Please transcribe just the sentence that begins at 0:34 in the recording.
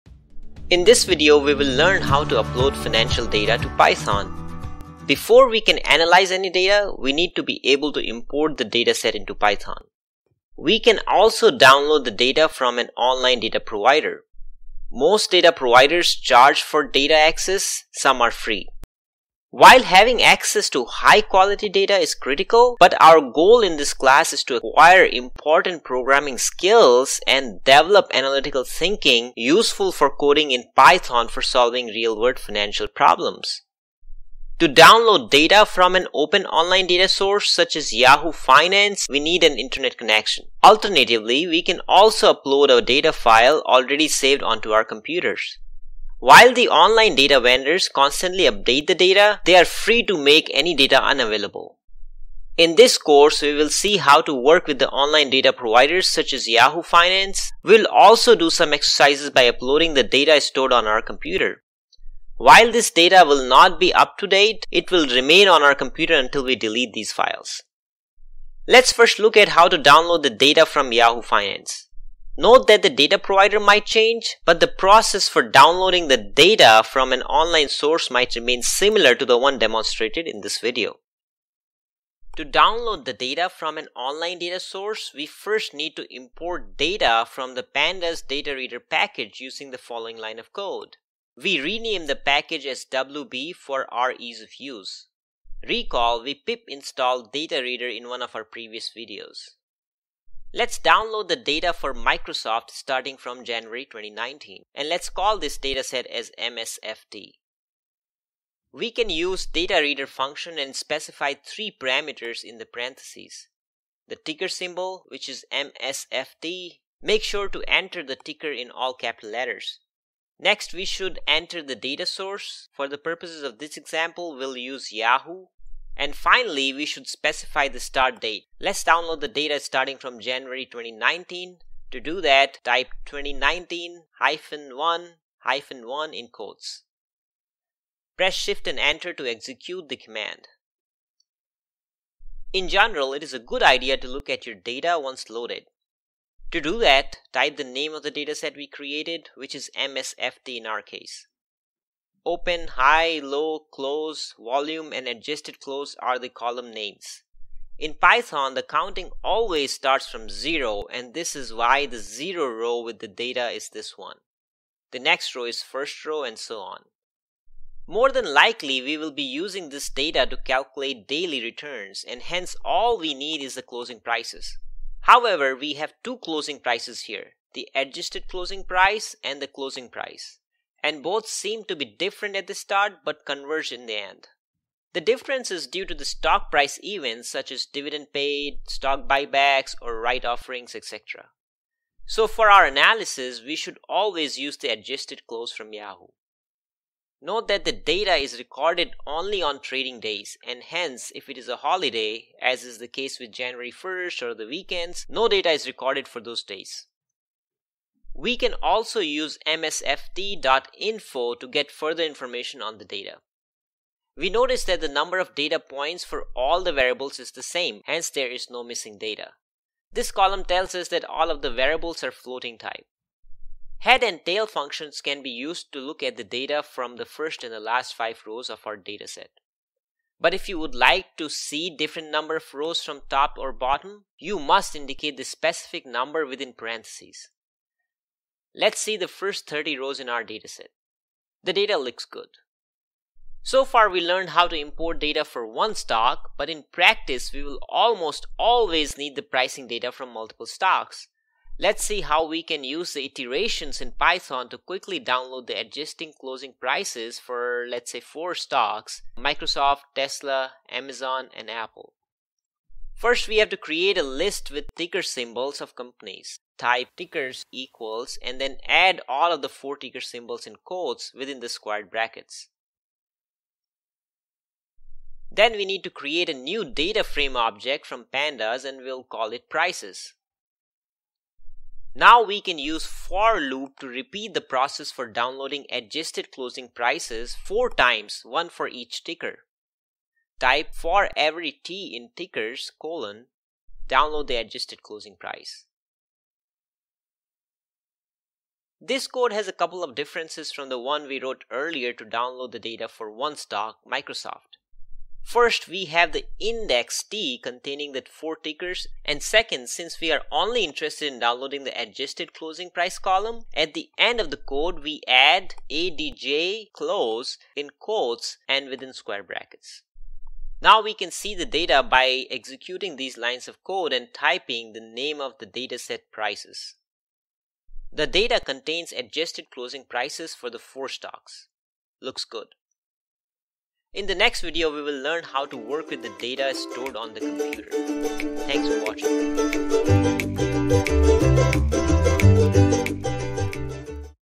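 To download data from an open online data source such as Yahoo Finance, we need an internet connection.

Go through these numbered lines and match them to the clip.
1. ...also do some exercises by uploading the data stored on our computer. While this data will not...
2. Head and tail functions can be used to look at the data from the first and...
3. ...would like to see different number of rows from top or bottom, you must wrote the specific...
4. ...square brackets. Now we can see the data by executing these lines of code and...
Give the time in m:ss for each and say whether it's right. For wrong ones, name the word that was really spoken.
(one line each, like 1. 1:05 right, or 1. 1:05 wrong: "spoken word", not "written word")
1. 0:57 right
2. 3:43 right
3. 3:50 wrong: "indicate", not "wrote"
4. 5:18 right.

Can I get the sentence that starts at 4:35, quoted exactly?
Then we need to create a new data frame object from pandas and we'll call it prices.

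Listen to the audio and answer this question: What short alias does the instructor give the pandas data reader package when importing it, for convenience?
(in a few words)
WB.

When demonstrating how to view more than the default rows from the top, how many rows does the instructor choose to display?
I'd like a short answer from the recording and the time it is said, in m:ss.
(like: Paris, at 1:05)
30, at 3:59.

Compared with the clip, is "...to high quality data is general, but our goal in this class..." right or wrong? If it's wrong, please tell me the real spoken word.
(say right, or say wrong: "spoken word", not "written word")
wrong: "critical", not "general".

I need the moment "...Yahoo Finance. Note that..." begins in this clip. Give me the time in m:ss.
1:10.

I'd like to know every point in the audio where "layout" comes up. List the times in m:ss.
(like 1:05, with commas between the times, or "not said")
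not said.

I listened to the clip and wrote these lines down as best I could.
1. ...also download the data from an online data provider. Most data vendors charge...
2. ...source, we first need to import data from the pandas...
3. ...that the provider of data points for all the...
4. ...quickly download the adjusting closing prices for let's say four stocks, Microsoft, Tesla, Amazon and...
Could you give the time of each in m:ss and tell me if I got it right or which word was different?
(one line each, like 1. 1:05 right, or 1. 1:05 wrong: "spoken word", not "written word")
1. 0:11 wrong: "providers", not "vendors"
2. 1:24 right
3. 3:34 wrong: "number", not "provider"
4. 4:14 right.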